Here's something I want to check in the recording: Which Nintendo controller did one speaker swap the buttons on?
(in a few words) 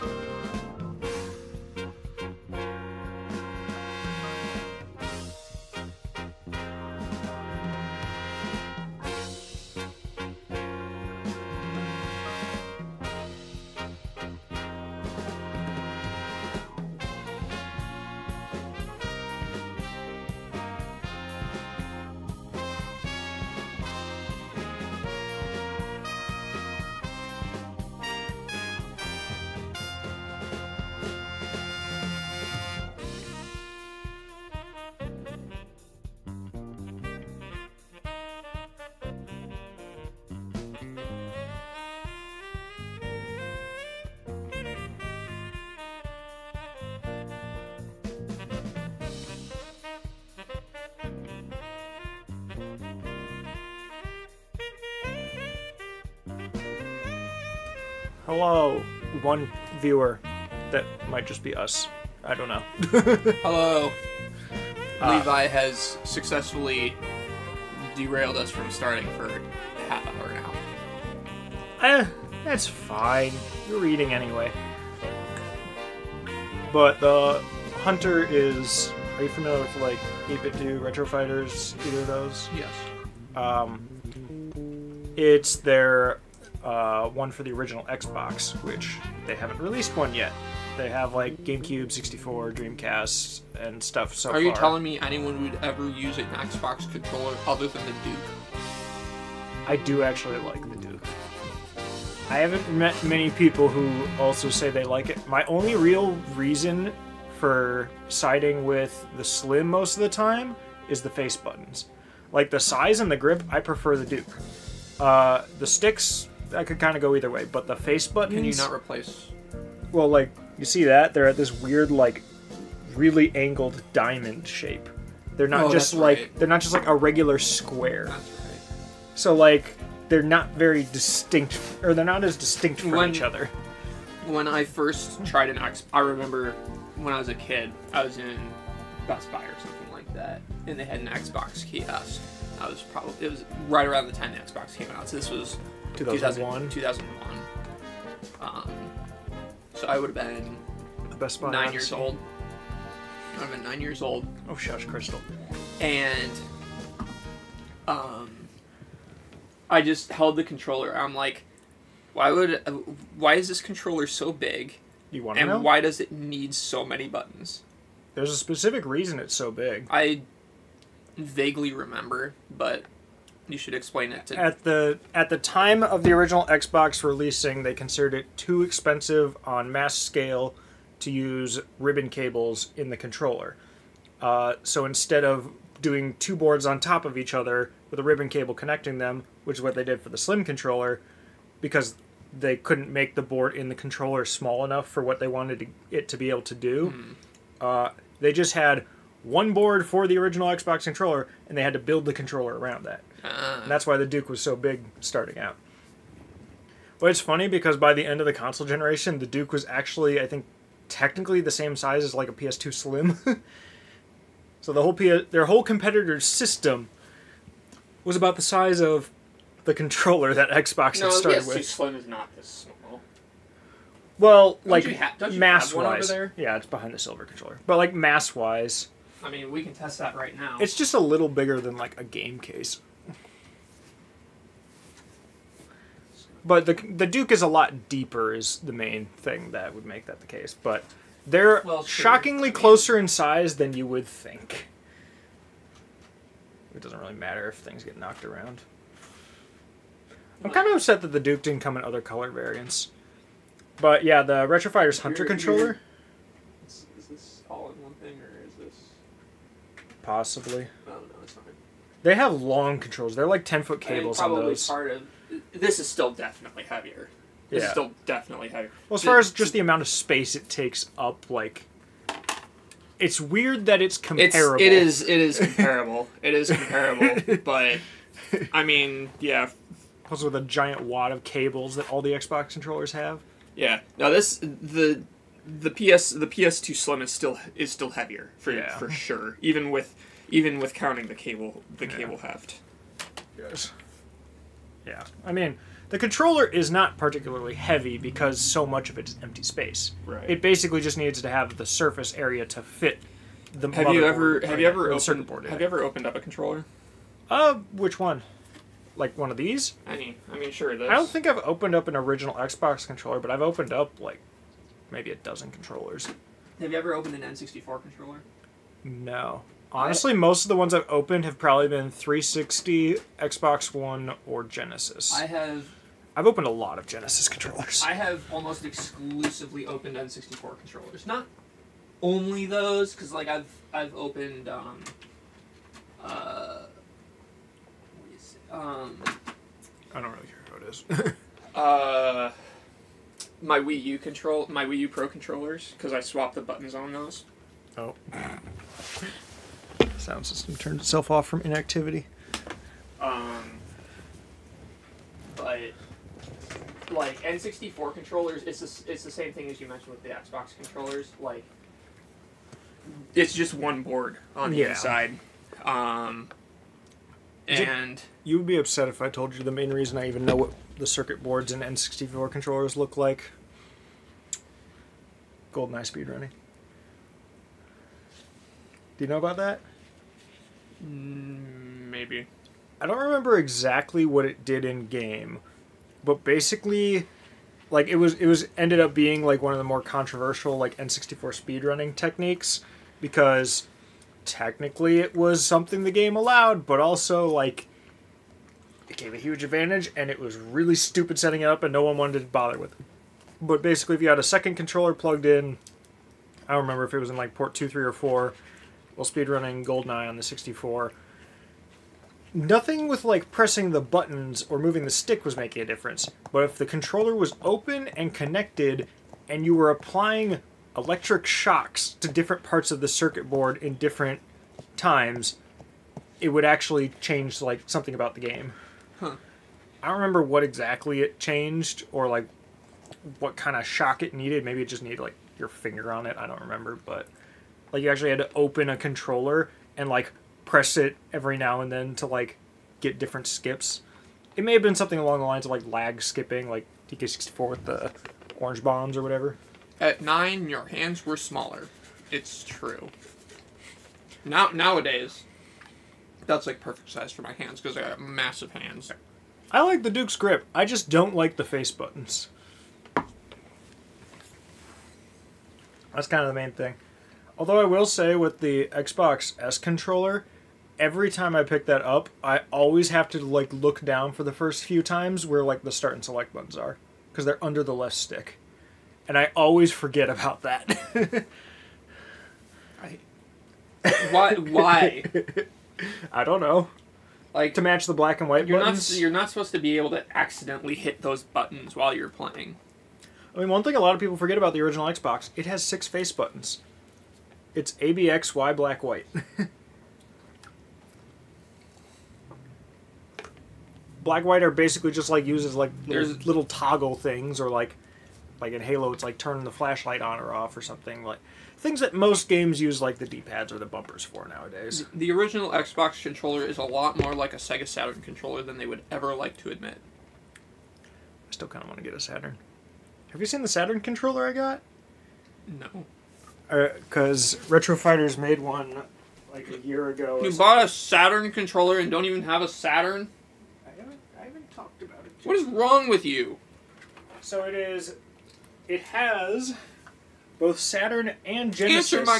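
Wii U Pro controllers.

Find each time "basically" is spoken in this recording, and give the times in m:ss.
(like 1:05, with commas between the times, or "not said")
5:00, 6:26, 6:43, 8:24.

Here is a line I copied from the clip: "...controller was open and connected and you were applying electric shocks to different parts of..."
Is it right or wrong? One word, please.
right.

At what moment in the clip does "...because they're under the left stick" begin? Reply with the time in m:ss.
7:57.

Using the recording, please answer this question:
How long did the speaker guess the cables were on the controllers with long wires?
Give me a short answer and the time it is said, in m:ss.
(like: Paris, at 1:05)
10 feet, at 4:23.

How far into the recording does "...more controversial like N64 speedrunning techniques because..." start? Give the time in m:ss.
6:29.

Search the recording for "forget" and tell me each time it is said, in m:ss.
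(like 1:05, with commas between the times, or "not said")
7:59, 8:14.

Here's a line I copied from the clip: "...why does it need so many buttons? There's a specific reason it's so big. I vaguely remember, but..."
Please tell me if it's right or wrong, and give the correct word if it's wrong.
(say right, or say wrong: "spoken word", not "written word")
right.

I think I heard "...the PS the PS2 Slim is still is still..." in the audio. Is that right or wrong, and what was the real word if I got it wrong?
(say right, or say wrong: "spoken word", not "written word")
right.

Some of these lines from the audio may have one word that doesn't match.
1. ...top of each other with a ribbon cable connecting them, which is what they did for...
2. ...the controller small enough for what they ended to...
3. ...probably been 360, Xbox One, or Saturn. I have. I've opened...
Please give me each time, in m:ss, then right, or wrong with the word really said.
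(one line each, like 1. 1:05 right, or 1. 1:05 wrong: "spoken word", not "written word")
1. 3:06 right
2. 3:13 wrong: "wanted", not "ended"
3. 5:21 wrong: "Genesis", not "Saturn".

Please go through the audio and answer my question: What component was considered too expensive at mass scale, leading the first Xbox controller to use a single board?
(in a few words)
Ribbon cables.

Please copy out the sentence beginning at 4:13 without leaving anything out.
But yeah, the Fighters Hunter controller.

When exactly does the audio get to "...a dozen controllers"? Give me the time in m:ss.
5:15.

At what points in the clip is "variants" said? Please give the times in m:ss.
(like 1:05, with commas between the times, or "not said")
4:12.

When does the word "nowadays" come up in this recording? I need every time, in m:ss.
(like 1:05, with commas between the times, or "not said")
7:34, 8:34.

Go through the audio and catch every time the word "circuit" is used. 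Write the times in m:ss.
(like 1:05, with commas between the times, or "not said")
6:10, 7:02.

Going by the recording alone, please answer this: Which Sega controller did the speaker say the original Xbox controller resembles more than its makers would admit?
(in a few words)
Sega Saturn controller.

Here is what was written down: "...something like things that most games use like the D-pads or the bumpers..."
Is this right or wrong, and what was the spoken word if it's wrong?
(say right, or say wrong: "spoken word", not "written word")
right.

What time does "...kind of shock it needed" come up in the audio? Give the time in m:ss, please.
7:13.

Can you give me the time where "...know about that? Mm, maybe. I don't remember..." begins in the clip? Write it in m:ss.
6:19.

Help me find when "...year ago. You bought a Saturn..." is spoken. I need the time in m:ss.
8:49.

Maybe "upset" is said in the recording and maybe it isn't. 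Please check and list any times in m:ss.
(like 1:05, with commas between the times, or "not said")
4:10, 6:08.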